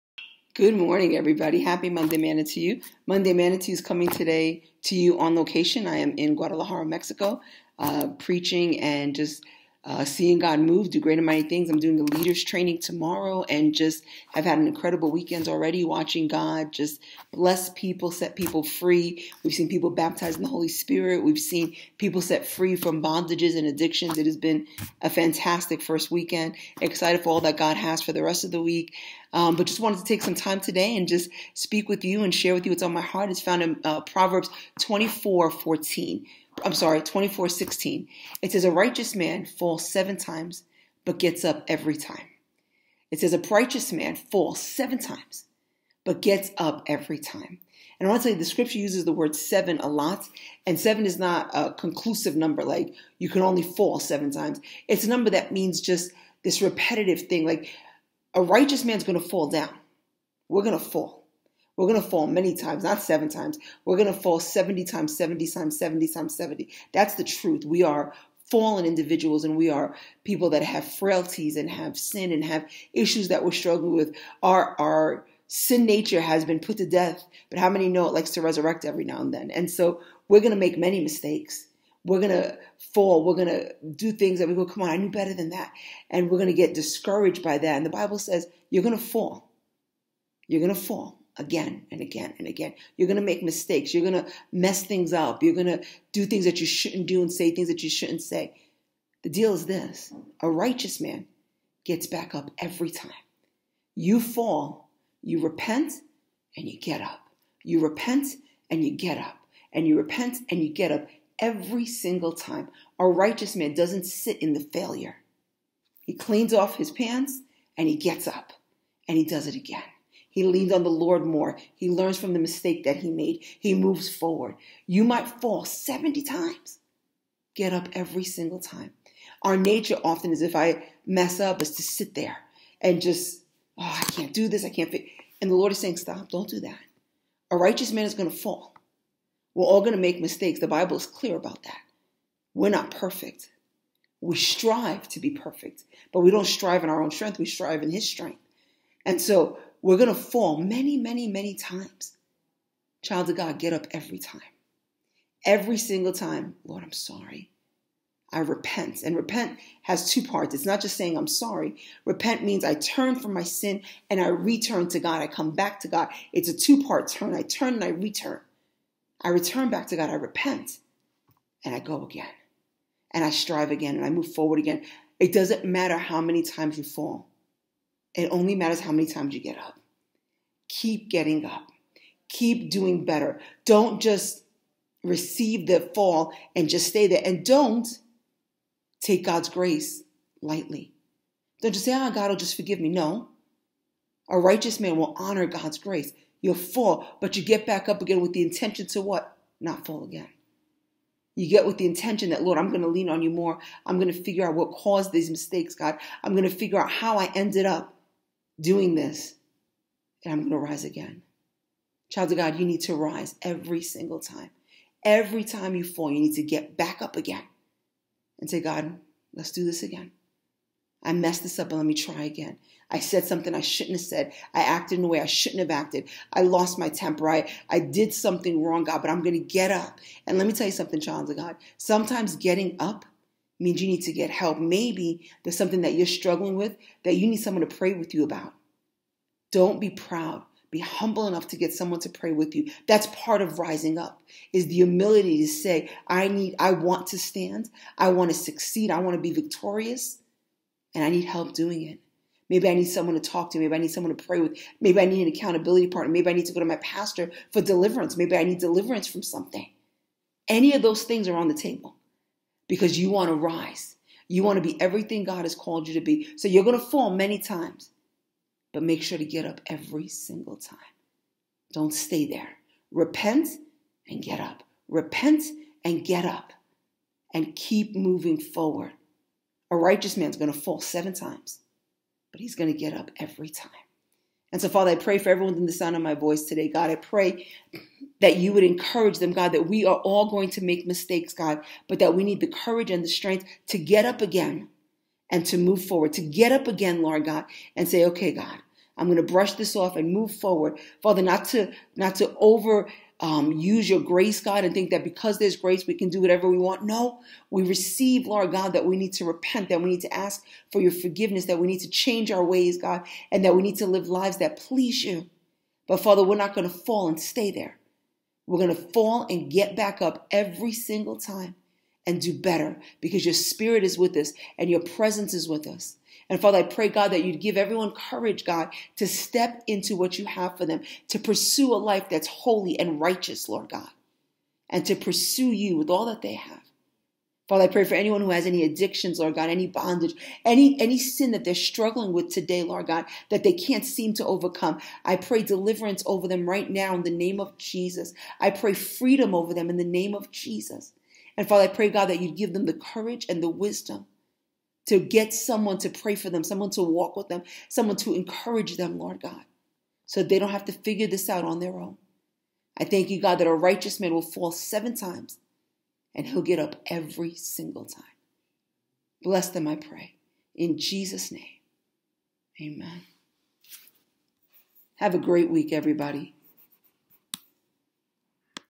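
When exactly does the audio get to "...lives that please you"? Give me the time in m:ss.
5:14.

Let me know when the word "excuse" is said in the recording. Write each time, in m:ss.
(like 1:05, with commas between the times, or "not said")
not said.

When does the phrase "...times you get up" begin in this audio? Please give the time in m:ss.
2:59.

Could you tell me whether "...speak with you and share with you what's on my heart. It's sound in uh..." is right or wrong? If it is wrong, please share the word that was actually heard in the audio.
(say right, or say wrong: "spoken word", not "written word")
wrong: "found", not "sound".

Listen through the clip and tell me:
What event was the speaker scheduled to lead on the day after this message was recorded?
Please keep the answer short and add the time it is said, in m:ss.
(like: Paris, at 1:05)
leaders training, at 0:12.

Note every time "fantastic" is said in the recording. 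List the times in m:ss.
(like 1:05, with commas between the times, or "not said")
0:25.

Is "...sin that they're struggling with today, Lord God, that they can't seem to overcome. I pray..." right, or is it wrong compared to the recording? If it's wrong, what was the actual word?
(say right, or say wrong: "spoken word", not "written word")
right.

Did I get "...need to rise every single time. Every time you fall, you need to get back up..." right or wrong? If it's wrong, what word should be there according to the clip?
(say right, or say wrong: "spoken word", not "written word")
right.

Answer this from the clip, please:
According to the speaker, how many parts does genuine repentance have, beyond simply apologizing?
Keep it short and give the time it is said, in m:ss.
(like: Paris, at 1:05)
2, at 2:40.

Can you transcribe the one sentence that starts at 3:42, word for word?
I said something I shouldn't have said.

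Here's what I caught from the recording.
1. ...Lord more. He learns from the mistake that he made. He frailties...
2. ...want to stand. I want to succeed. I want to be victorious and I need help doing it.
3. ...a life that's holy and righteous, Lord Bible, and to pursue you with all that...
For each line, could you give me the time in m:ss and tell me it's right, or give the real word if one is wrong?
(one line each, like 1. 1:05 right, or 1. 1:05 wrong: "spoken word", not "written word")
1. 2:00 wrong: "moves", not "frailties"
2. 4:06 right
3. 5:31 wrong: "God", not "Bible".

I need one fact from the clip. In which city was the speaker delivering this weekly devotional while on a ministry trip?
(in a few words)
Guadalajara.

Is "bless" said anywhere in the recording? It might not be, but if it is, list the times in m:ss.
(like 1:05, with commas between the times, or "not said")
0:17, 6:09.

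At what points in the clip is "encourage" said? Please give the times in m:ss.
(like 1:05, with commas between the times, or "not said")
4:48, 5:58.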